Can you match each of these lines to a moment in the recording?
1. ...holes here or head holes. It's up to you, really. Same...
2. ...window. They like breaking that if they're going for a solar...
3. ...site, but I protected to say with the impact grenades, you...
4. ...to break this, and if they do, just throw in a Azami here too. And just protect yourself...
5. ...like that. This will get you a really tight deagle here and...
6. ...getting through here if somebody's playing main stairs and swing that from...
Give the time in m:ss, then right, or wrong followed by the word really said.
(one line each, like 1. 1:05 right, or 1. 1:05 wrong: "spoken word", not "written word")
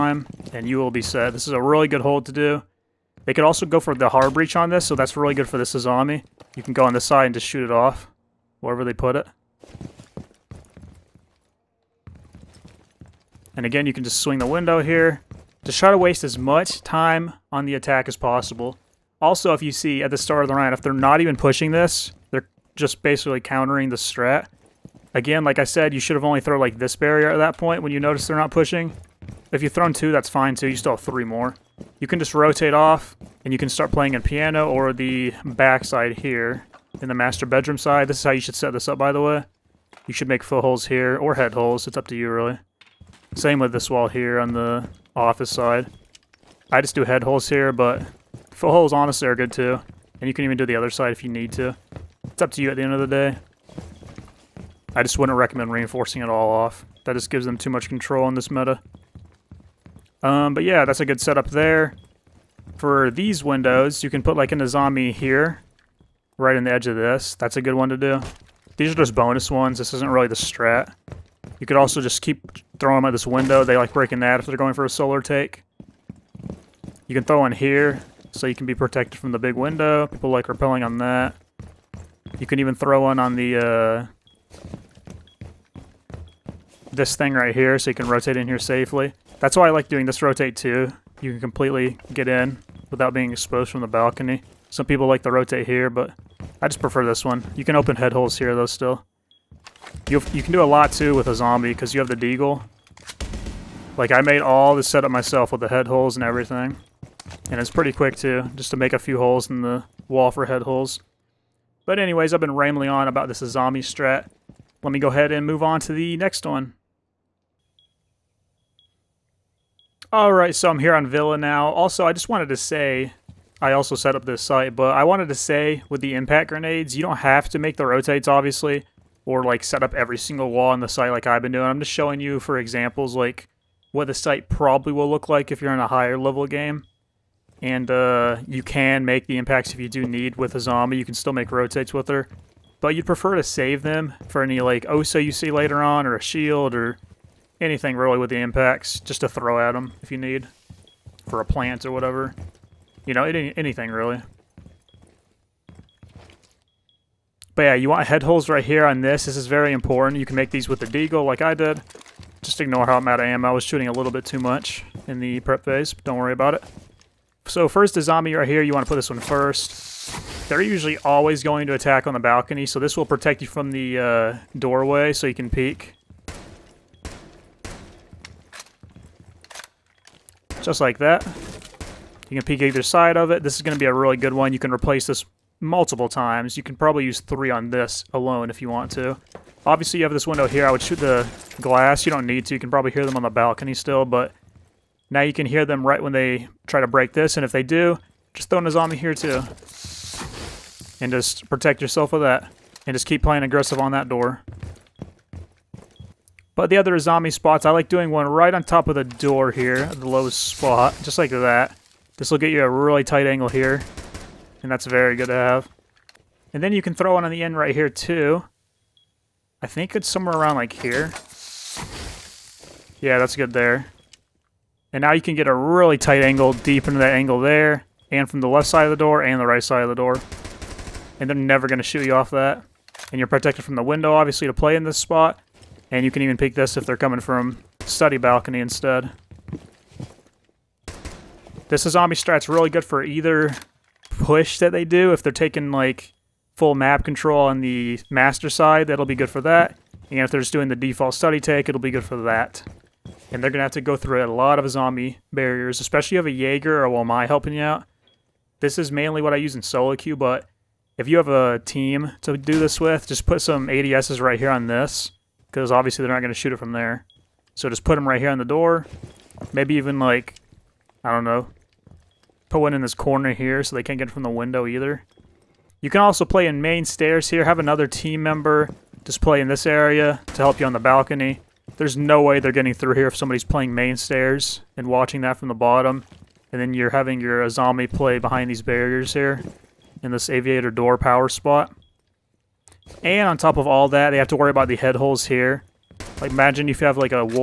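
1. 0:40 right
2. 1:13 right
3. 2:04 wrong: "wanted", not "protected"
4. 3:16 right
5. 3:31 wrong: "angle", not "deagle"
6. 4:42 wrong: "watching", not "swing".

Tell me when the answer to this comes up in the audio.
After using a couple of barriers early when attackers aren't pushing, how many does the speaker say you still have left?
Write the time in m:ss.
0:31.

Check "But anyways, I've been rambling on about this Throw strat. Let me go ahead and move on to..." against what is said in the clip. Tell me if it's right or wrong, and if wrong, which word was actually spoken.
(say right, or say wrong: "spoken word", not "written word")
wrong: "Azami", not "Throw".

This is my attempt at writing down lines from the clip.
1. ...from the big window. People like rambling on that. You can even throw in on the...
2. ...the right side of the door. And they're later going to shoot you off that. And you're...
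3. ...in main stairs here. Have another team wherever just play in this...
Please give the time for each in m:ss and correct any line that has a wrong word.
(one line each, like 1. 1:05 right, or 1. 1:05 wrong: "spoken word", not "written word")
1. 1:19 wrong: "repelling", not "rambling"
2. 3:49 wrong: "never", not "later"
3. 4:36 wrong: "member", not "wherever".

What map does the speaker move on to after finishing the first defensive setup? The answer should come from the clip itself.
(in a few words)
Villa.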